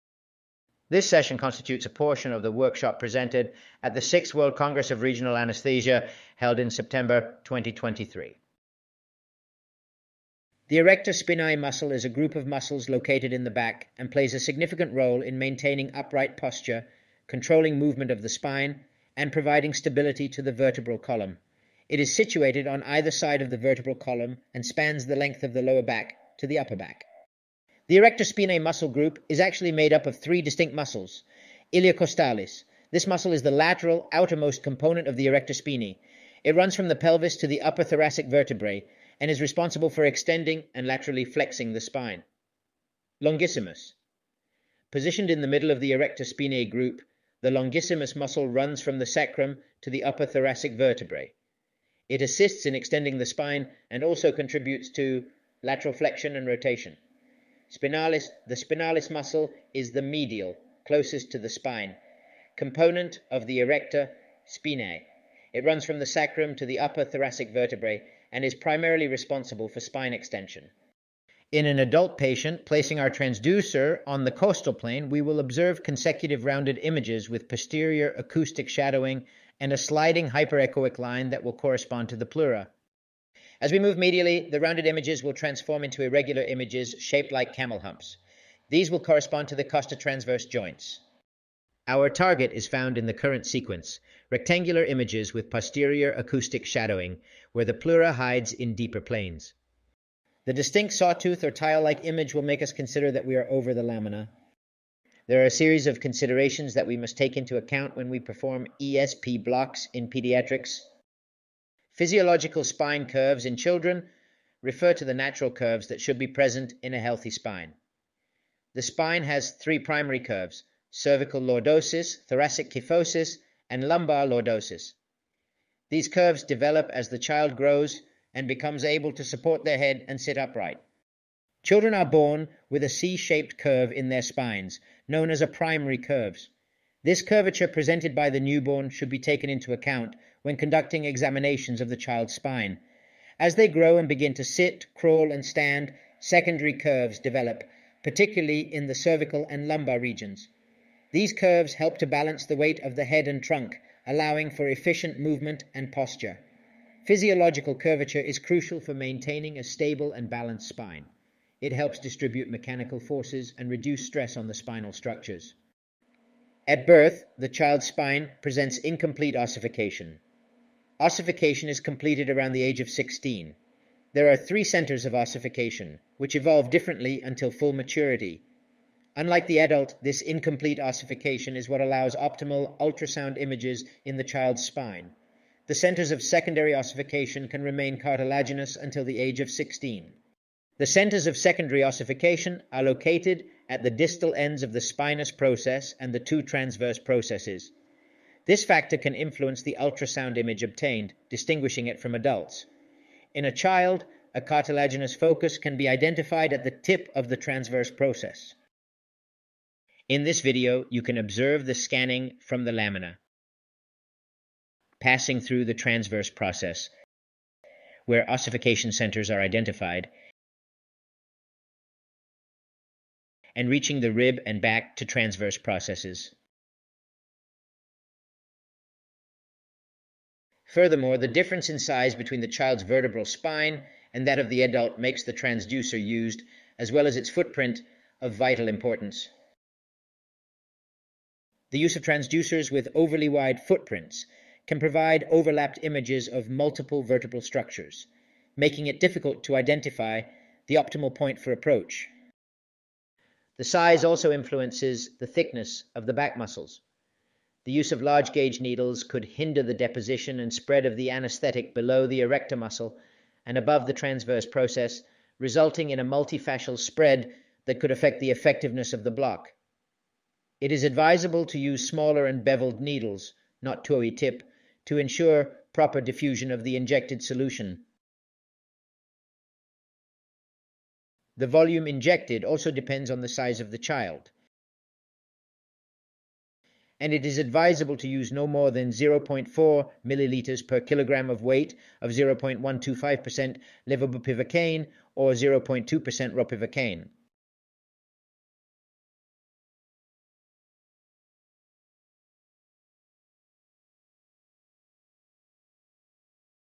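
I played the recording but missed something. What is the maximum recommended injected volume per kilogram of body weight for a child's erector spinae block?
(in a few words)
0.4 milliliters.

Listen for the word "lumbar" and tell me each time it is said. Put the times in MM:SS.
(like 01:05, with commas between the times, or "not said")
02:03, 02:29.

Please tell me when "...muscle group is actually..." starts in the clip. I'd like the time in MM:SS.
00:28.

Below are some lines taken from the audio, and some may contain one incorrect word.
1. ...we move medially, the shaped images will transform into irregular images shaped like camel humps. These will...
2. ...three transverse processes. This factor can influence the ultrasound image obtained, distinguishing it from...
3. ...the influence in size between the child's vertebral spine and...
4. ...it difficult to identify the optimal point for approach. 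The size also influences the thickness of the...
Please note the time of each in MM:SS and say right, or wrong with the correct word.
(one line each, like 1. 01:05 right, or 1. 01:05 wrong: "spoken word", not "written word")
1. 01:23 wrong: "rounded", not "shaped"
2. 03:16 wrong: "two", not "three"
3. 03:51 wrong: "difference", not "influence"
4. 04:08 right.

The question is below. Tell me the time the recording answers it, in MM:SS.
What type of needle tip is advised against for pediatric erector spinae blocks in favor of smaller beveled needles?
04:33.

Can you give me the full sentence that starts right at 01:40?
The distinct sawtooth or tile-like image will make us consider that we are over the lamina.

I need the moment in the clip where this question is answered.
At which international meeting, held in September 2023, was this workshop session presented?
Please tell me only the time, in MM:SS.
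00:04.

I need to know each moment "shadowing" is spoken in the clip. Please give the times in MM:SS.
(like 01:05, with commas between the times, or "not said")
01:18, 01:36.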